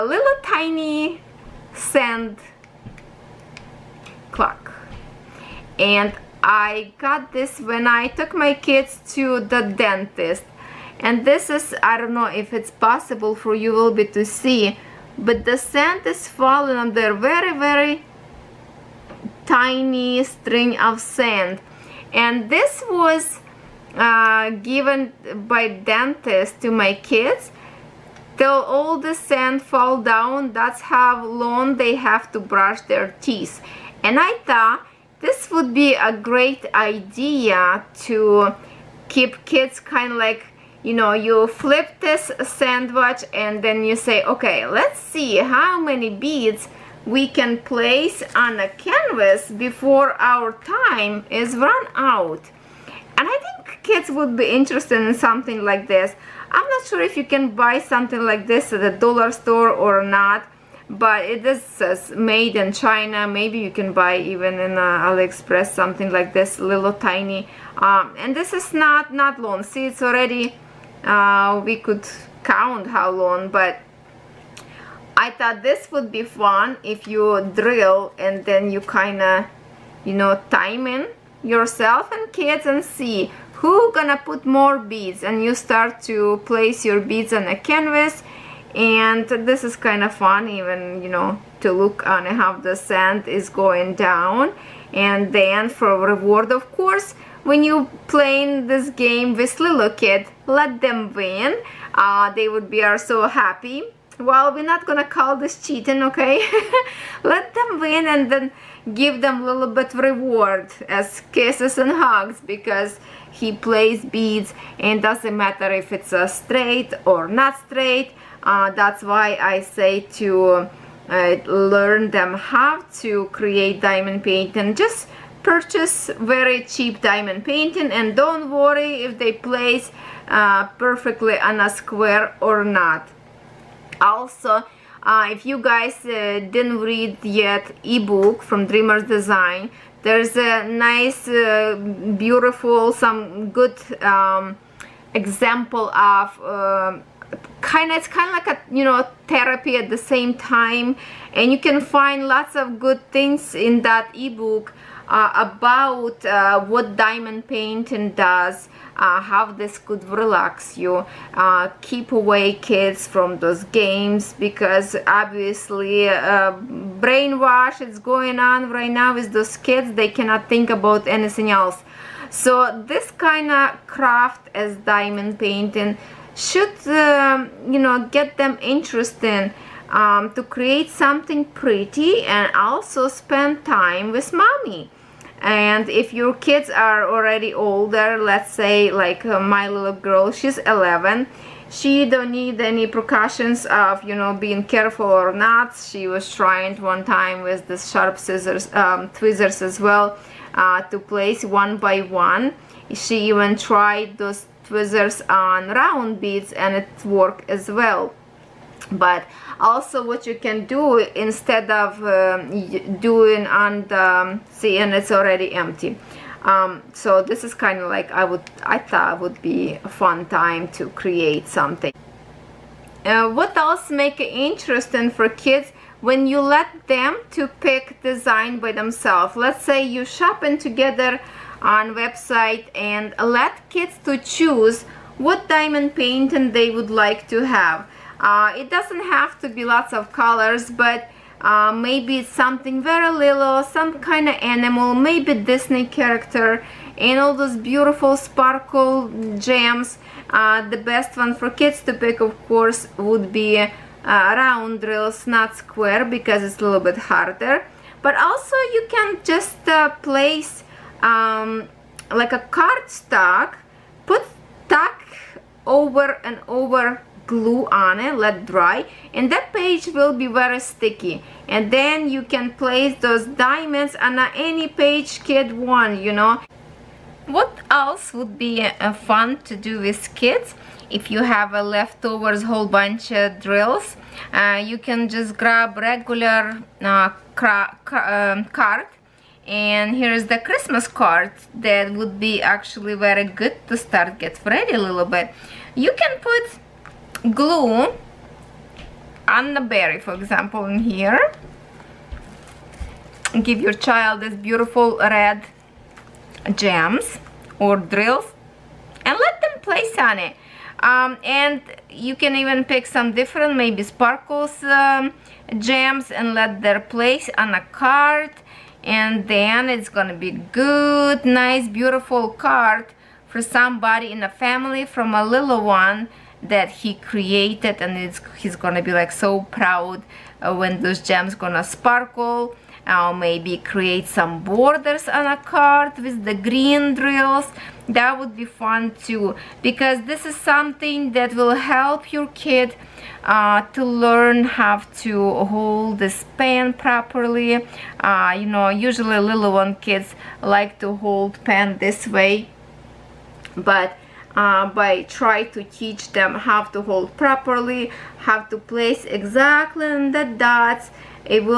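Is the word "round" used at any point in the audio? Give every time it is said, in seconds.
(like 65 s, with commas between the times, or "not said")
205 s, 254 s.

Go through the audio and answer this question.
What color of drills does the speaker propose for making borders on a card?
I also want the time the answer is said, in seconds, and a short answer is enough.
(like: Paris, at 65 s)
Green, at 336 s.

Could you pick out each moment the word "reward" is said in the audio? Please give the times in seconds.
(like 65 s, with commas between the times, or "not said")
95 s, 109 s.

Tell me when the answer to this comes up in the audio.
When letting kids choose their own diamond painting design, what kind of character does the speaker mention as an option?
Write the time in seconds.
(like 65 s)
245 s.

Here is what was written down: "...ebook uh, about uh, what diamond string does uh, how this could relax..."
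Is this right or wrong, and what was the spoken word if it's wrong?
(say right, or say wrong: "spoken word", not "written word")
wrong: "painting", not "string".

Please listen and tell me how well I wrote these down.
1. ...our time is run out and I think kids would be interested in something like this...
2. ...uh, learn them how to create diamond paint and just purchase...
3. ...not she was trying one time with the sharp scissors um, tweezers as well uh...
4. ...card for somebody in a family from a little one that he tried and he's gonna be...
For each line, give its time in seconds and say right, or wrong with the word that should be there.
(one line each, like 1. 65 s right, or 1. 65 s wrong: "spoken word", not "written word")
1. 50 s right
2. 121 s right
3. 195 s right
4. 322 s wrong: "created", not "tried".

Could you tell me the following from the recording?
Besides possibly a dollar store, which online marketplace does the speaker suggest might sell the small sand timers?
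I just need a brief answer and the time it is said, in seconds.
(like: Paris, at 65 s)
AliExpress, at 65 s.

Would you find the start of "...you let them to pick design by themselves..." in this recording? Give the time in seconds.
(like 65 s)
226 s.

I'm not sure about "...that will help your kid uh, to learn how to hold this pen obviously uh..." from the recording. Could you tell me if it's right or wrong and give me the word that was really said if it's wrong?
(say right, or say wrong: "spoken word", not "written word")
wrong: "properly", not "obviously".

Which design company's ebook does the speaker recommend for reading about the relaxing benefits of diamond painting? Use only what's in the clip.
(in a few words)
Dreamers Design.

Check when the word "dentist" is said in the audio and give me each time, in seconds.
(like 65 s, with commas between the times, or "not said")
9 s, 25 s.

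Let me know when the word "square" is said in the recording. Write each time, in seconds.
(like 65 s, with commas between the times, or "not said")
131 s, 255 s.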